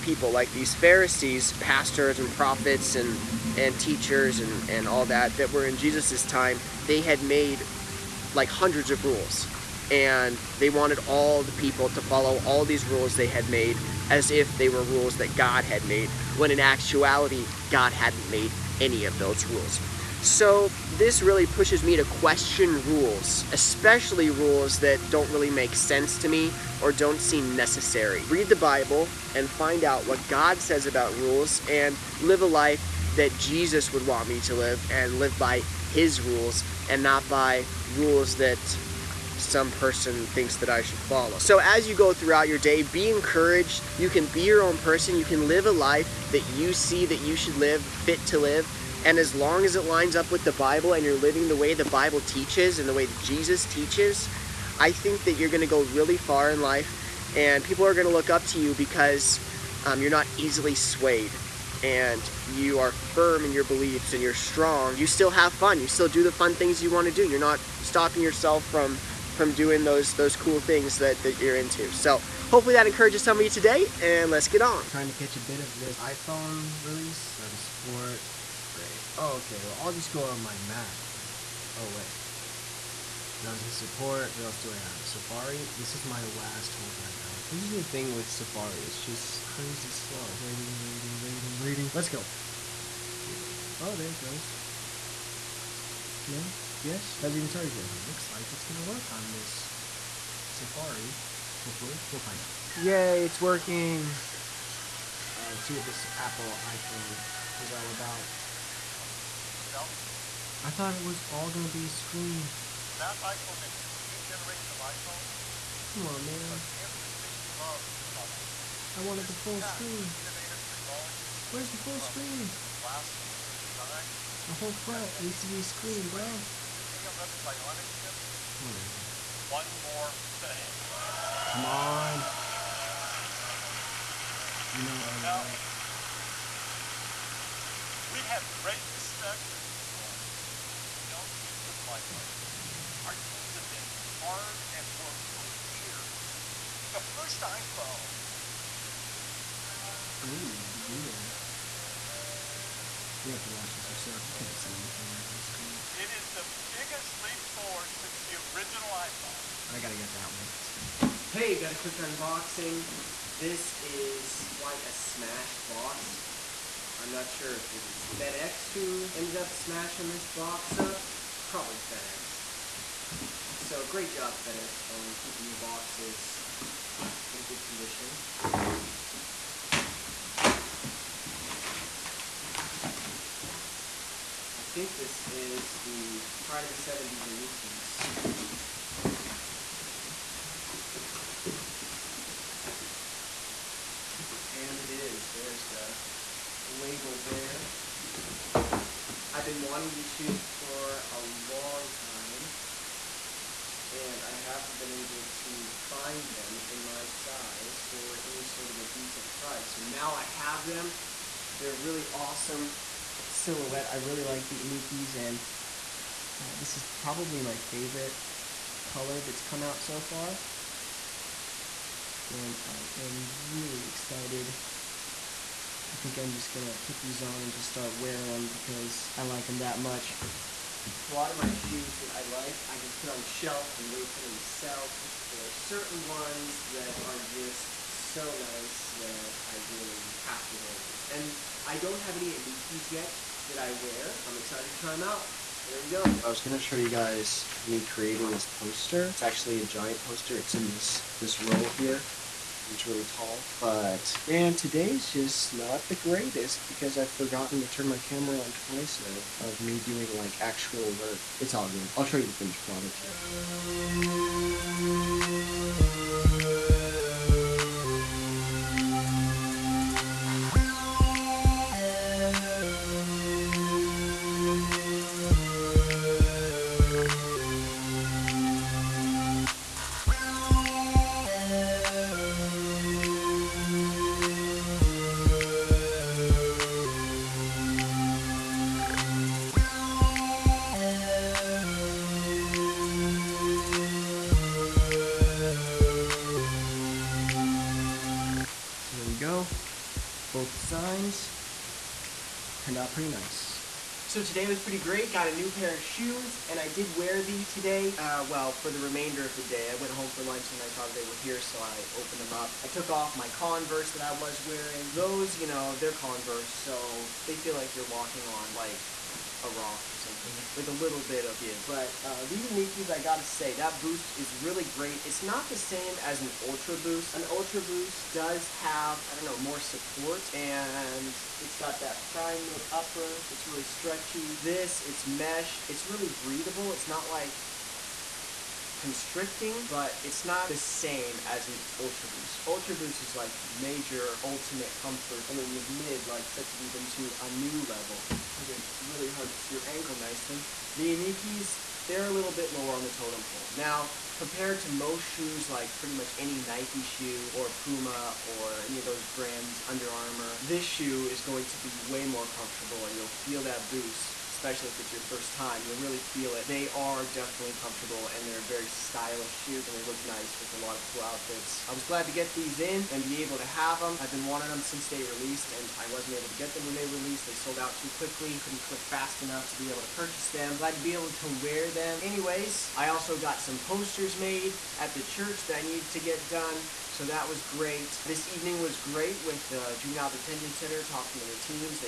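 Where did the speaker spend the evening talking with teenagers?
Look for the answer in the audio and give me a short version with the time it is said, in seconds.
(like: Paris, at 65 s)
Juvenile Detention Center, at 389 s.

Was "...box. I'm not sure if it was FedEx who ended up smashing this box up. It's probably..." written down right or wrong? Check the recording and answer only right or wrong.
right.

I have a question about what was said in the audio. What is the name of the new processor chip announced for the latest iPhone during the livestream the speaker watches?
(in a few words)
A11 Bionic.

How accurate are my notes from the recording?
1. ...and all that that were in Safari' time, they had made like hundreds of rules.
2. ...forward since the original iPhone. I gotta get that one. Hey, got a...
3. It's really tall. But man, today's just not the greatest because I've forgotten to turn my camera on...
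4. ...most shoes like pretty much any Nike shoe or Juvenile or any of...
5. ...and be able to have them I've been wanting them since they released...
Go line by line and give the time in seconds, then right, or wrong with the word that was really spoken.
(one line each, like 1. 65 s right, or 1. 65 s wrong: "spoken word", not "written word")
1. 4 s wrong: "Jesus", not "Safari"
2. 157 s right
3. 252 s right
4. 354 s wrong: "Puma", not "Juvenile"
5. 372 s right.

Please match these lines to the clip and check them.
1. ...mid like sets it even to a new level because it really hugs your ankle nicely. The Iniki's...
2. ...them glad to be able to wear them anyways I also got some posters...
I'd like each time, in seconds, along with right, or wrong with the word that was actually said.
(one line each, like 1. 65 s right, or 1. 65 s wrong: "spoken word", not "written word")
1. 345 s right
2. 380 s right.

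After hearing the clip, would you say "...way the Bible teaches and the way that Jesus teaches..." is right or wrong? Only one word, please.
right.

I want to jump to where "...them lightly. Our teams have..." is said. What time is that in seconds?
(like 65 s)
141 s.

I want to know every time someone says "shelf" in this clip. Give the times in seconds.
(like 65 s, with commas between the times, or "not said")
233 s.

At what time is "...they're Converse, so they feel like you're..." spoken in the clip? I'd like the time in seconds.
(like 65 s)
315 s.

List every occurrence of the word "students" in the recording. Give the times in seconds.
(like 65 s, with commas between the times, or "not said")
not said.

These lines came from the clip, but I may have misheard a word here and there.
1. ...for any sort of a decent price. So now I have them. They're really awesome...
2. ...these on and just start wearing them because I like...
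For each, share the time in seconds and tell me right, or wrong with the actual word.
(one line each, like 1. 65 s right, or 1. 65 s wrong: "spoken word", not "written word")
1. 207 s right
2. 226 s right.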